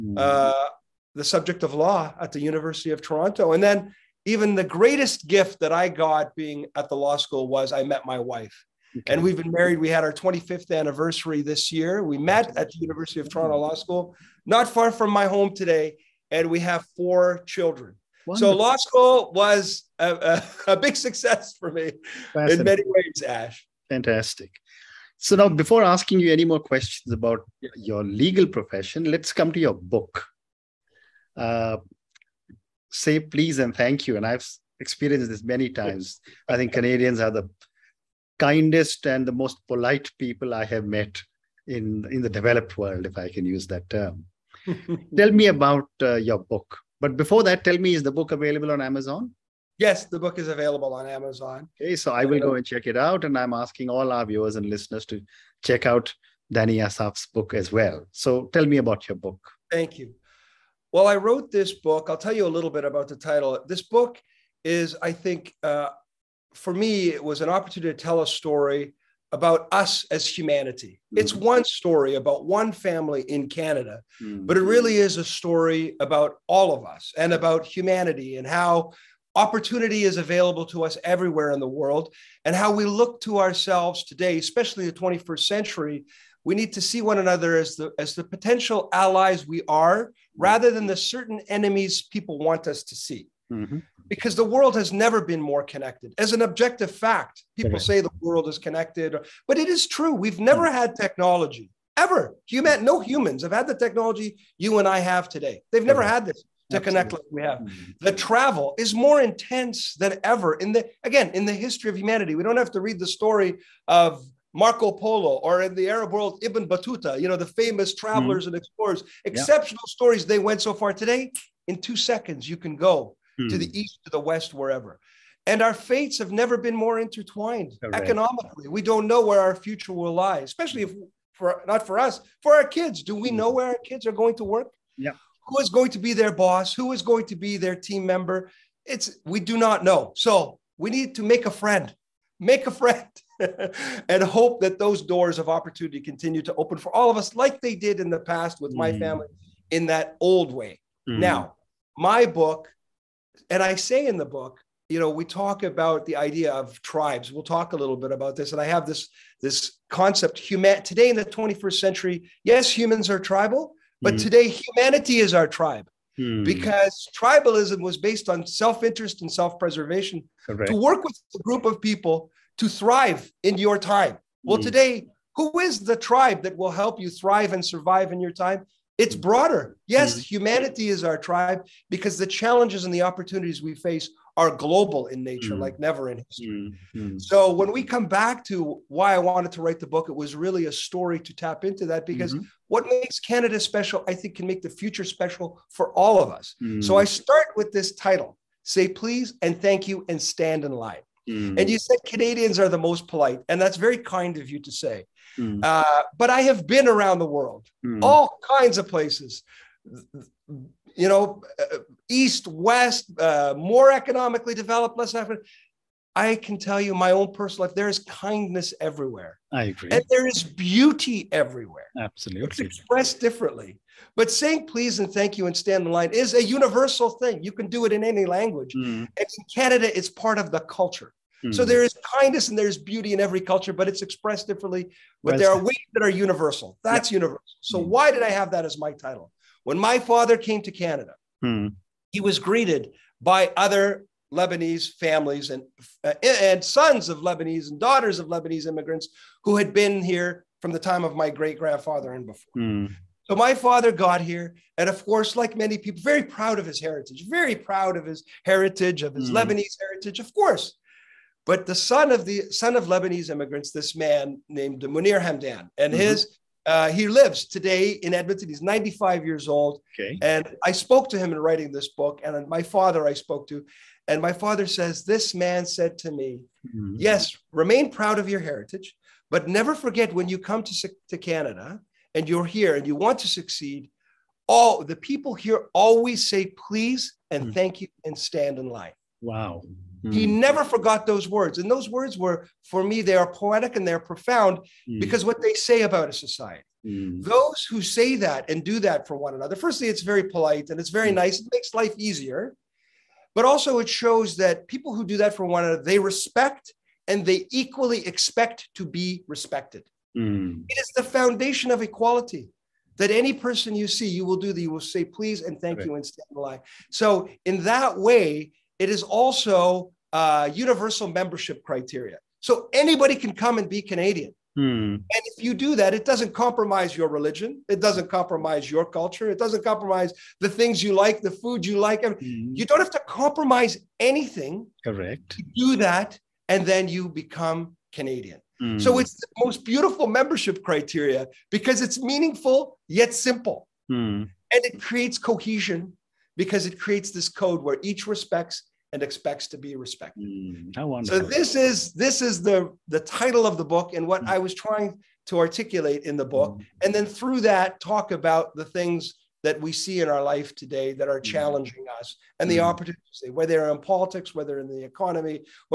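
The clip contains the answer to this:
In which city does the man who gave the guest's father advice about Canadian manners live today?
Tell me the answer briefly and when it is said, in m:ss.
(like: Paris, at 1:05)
Edmonton, at 4:28.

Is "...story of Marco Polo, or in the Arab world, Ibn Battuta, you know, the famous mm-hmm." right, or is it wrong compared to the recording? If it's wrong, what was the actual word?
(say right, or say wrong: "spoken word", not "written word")
right.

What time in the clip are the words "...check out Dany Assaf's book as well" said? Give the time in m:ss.
0:55.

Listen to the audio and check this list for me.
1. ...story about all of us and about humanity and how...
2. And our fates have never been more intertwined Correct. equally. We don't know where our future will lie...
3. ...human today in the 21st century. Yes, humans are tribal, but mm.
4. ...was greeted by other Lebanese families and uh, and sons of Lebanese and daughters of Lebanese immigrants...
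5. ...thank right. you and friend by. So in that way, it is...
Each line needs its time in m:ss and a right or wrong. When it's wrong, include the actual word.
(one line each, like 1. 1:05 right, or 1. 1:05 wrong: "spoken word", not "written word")
1. 1:15 right
2. 2:05 wrong: "economically", not "equally"
3. 2:40 right
4. 4:02 right
5. 5:15 wrong: "stand", not "friend".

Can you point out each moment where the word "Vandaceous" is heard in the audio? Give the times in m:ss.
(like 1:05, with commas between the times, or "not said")
not said.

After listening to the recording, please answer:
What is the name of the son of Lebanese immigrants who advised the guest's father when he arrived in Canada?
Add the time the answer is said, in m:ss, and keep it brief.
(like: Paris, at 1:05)
Munir Hamdan, at 4:24.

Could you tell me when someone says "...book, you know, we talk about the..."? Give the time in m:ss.
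2:34.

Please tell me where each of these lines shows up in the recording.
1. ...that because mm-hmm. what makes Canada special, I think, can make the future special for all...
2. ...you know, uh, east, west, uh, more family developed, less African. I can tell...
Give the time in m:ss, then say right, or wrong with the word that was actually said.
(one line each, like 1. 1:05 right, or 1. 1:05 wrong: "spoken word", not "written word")
1. 3:11 right
2. 3:30 wrong: "economically", not "family".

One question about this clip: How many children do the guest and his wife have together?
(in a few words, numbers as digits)
4.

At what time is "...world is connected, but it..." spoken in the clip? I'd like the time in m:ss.
1:38.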